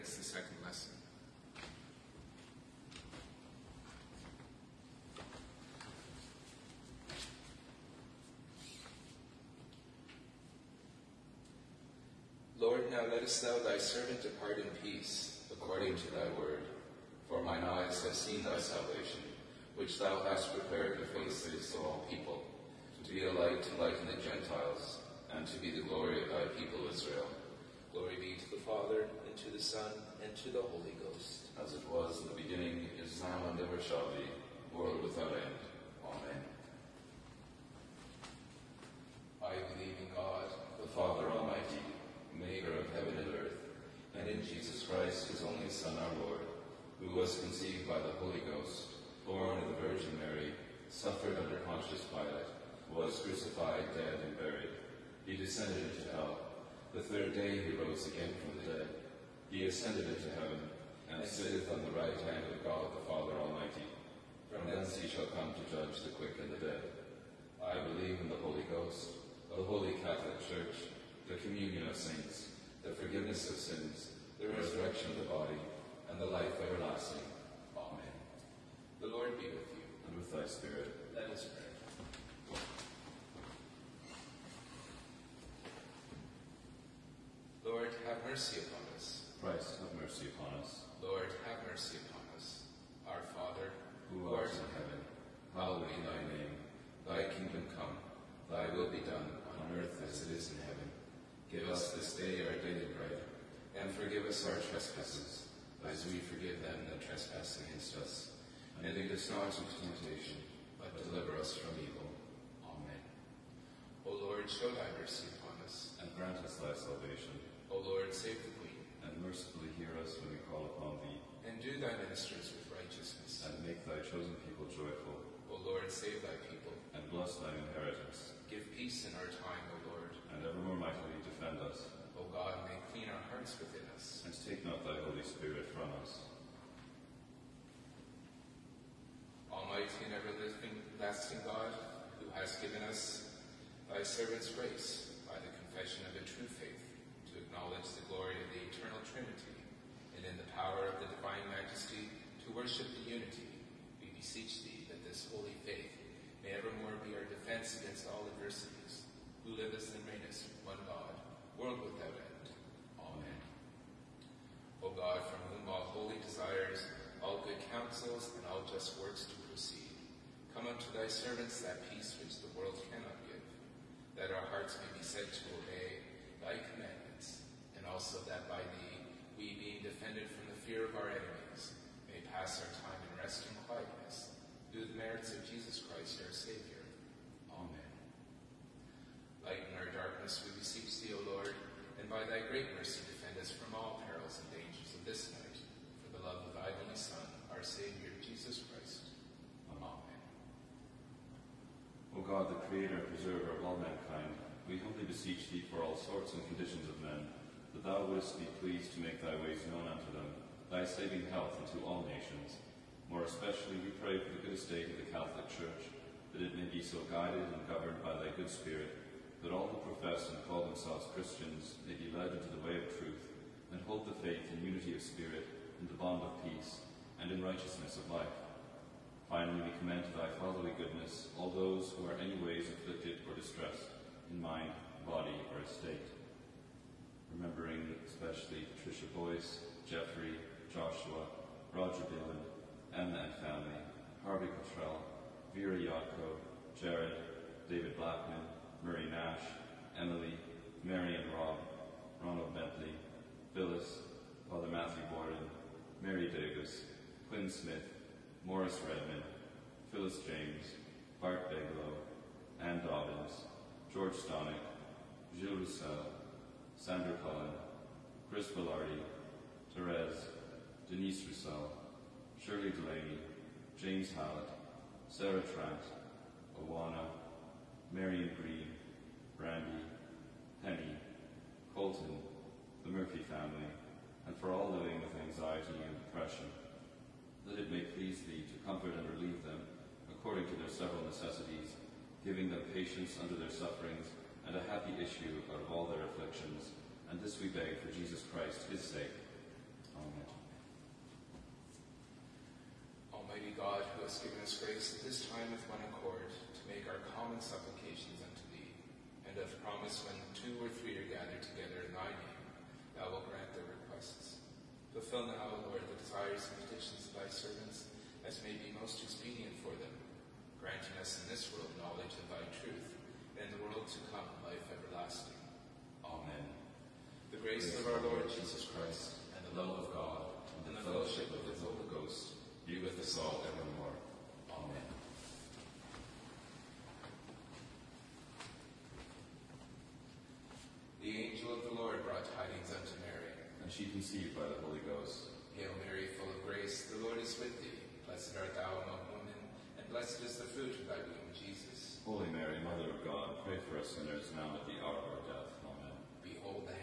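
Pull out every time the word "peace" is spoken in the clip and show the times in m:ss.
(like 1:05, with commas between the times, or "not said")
0:14, 2:08, 2:51, 3:46.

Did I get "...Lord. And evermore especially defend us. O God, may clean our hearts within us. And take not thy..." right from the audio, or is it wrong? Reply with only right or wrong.
wrong.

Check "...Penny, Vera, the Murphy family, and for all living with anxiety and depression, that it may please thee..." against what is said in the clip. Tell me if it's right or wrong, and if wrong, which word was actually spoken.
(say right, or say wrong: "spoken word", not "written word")
wrong: "Colton", not "Vera".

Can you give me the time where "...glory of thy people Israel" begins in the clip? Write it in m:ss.
0:25.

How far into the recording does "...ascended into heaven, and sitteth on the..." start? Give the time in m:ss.
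0:59.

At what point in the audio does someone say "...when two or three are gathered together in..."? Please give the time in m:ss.
5:10.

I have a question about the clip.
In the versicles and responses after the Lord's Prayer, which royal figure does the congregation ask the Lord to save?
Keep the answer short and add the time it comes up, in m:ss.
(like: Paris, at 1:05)
The Queen, at 1:58.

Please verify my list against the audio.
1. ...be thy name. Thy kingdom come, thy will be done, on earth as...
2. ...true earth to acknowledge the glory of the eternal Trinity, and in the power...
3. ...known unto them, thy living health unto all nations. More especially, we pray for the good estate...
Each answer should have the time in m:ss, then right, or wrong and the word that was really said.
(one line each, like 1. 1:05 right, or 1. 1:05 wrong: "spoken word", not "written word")
1. 1:35 right
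2. 2:26 wrong: "faith", not "earth"
3. 3:29 wrong: "saving", not "living".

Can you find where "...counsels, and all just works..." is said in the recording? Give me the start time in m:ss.
2:47.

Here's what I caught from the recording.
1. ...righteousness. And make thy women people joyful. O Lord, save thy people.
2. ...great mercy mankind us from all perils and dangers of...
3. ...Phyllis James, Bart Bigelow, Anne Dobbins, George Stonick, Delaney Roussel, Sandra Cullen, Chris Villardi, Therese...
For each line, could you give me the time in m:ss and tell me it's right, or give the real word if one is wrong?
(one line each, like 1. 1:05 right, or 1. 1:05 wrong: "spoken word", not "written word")
1. 2:02 wrong: "chosen", not "women"
2. 3:12 wrong: "defend", not "mankind"
3. 4:19 wrong: "Gilles", not "Delaney".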